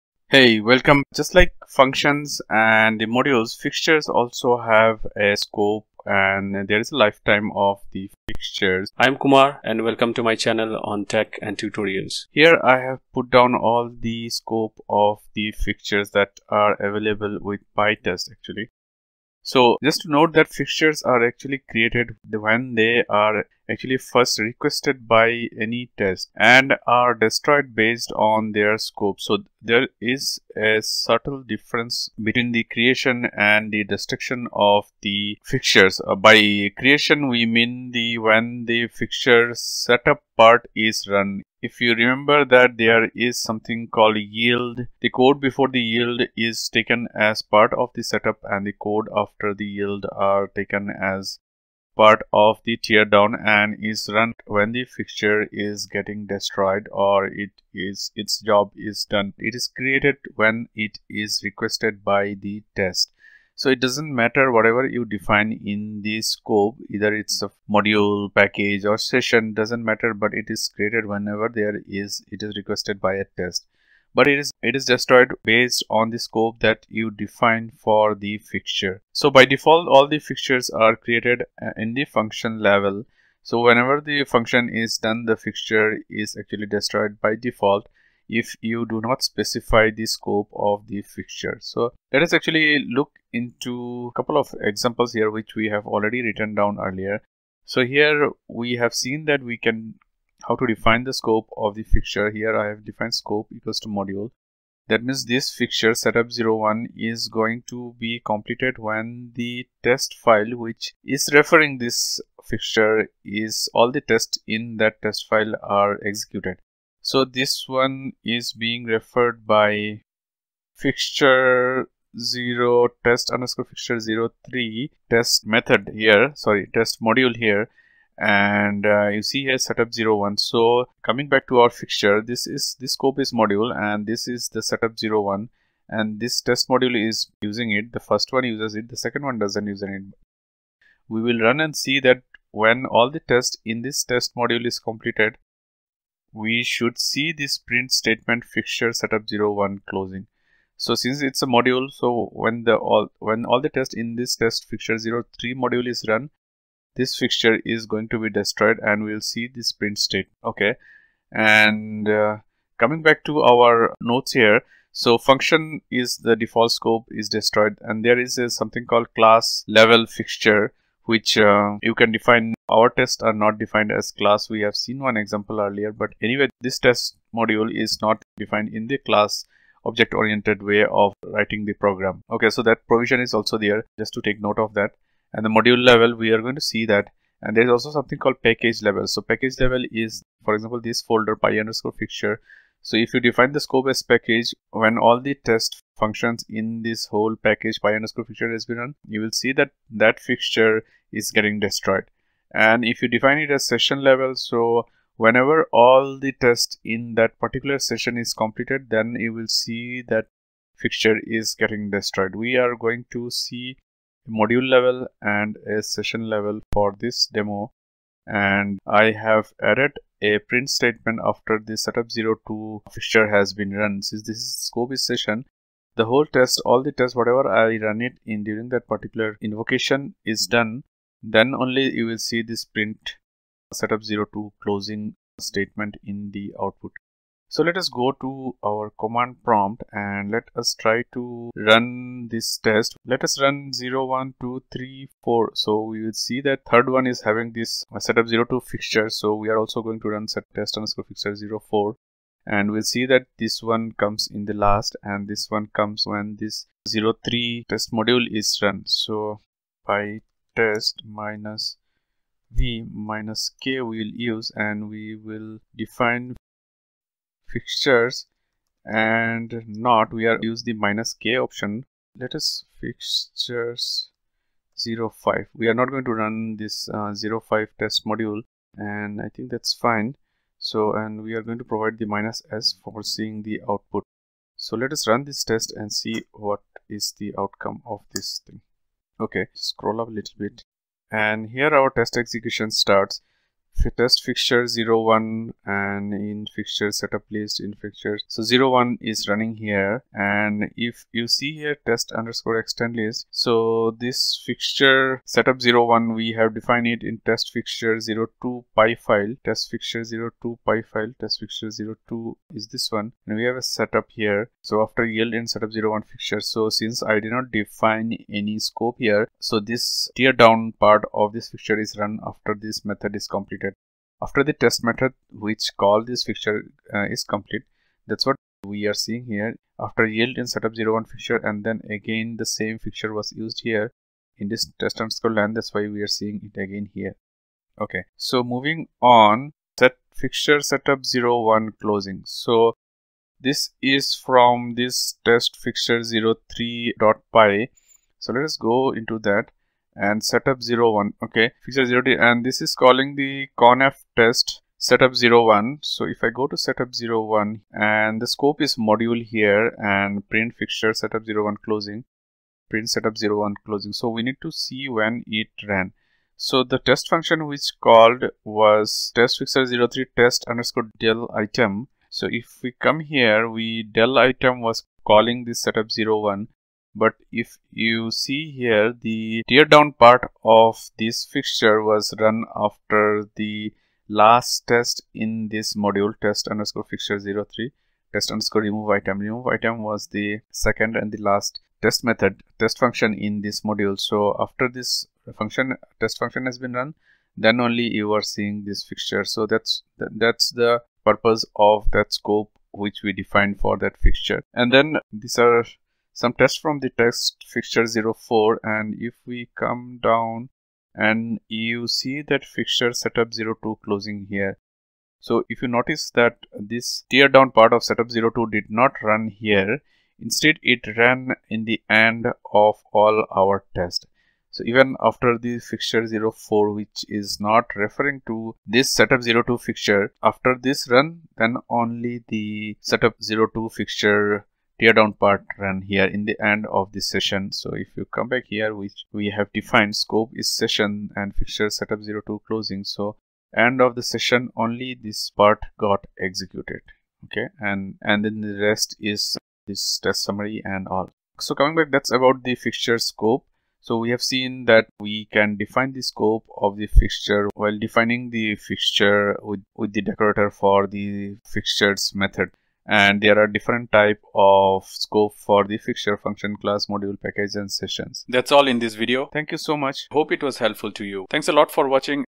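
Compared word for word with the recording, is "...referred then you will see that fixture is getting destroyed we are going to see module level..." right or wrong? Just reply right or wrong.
wrong.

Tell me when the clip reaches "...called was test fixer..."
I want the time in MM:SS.
06:07.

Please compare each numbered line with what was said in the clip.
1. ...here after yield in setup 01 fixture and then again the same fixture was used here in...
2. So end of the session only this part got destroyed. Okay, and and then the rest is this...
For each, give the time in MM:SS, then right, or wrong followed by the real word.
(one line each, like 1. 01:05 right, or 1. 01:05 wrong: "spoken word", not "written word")
1. 05:29 right
2. 07:22 wrong: "executed", not "destroyed".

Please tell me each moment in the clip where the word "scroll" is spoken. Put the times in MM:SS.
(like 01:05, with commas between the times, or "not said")
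04:49.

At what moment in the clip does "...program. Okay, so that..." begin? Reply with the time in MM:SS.
03:01.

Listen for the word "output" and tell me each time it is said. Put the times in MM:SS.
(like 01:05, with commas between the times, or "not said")
03:56, 04:43.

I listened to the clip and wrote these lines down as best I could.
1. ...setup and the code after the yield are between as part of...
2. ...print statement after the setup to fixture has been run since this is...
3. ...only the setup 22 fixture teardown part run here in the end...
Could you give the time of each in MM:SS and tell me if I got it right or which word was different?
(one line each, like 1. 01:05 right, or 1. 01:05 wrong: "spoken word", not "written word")
1. 00:48 wrong: "taken", not "between"
2. 03:40 right
3. 07:11 wrong: "02", not "22".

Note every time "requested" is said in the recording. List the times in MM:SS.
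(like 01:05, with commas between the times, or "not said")
00:24, 01:01, 01:12.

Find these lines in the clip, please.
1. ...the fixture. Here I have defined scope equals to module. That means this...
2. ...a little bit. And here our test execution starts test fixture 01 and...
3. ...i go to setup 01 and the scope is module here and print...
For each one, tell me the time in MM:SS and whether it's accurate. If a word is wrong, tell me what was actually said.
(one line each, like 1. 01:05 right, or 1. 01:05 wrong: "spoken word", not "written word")
1. 01:41 right
2. 04:50 right
3. 05:56 right.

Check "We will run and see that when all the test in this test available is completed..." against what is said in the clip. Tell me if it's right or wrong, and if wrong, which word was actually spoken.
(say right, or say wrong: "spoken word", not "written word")
wrong: "module", not "available".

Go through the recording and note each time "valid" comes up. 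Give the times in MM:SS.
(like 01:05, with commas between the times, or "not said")
not said.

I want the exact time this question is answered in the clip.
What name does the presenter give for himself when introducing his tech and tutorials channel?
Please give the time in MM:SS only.
00:09.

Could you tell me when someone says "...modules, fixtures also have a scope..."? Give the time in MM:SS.
00:03.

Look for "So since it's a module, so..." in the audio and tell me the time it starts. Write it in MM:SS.
02:30.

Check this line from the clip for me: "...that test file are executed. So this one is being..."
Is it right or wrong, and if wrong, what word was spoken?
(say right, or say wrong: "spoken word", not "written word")
right.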